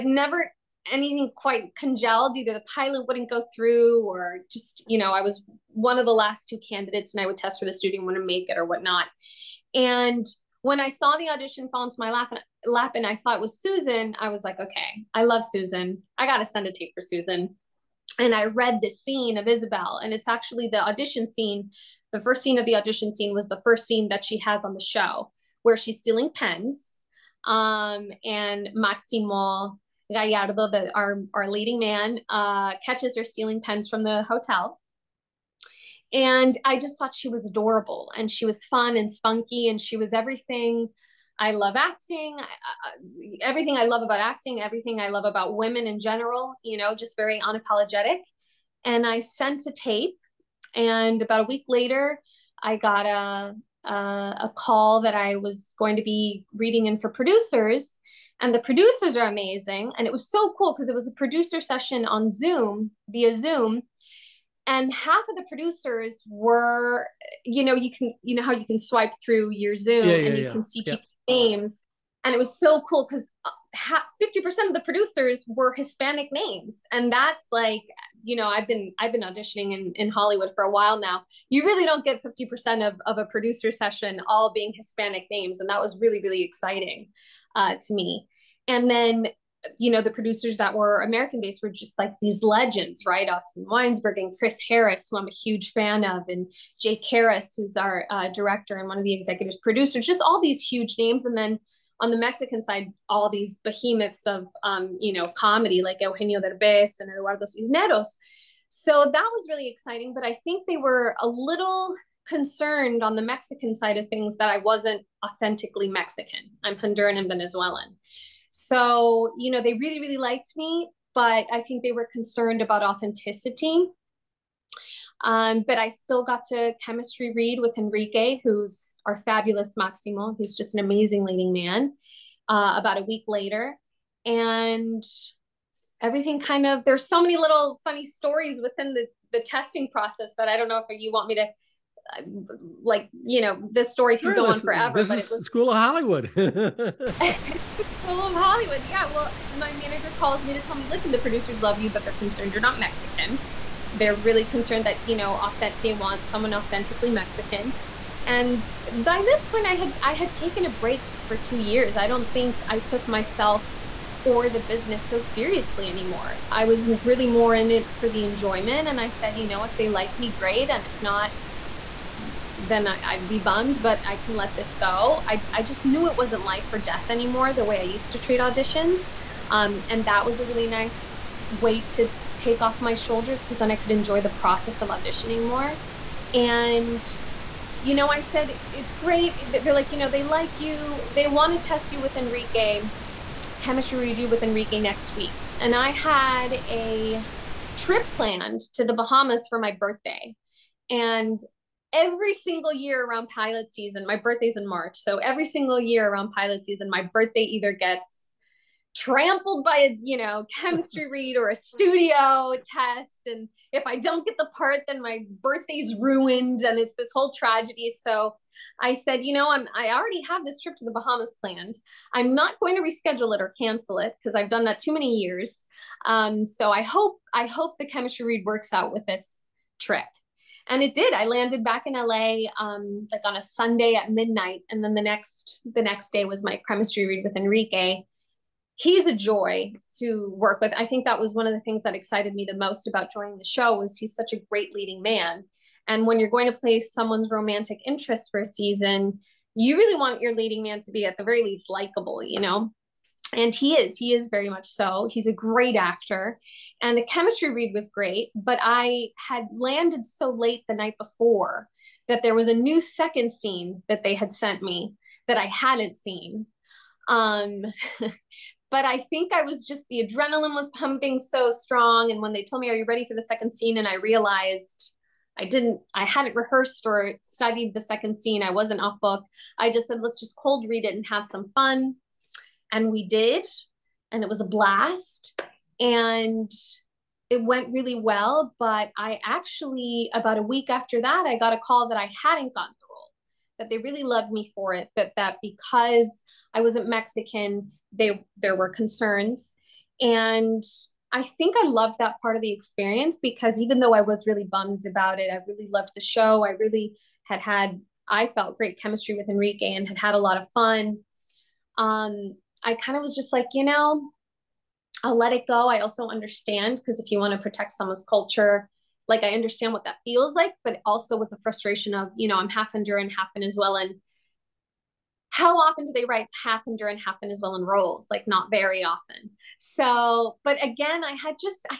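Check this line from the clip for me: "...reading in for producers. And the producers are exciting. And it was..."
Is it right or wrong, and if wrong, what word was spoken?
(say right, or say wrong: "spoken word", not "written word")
wrong: "amazing", not "exciting".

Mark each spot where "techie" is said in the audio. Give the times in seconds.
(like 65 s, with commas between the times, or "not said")
not said.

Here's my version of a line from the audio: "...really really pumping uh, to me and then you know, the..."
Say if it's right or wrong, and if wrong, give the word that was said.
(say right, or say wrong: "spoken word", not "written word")
wrong: "exciting", not "pumping".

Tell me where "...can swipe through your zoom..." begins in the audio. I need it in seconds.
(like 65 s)
68 s.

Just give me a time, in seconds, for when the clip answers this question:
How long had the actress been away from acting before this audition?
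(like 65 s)
161 s.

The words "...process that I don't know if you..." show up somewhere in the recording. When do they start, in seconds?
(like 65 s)
139 s.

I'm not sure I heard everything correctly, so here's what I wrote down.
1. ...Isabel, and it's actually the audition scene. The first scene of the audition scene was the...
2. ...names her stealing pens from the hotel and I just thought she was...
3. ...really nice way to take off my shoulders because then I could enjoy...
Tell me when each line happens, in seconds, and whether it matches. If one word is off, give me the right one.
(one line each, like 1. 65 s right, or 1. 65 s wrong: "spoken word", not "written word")
1. 19 s right
2. 32 s wrong: "catches", not "names"
3. 180 s right.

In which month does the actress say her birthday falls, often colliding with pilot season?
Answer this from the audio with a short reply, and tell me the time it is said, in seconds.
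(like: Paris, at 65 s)
March, at 204 s.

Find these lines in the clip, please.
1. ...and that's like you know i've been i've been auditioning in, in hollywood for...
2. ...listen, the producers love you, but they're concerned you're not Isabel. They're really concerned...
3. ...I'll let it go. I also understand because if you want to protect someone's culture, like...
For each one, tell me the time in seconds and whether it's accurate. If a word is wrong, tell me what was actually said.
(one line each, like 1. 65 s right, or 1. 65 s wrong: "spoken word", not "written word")
1. 76 s right
2. 150 s wrong: "Mexican", not "Isabel"
3. 315 s right.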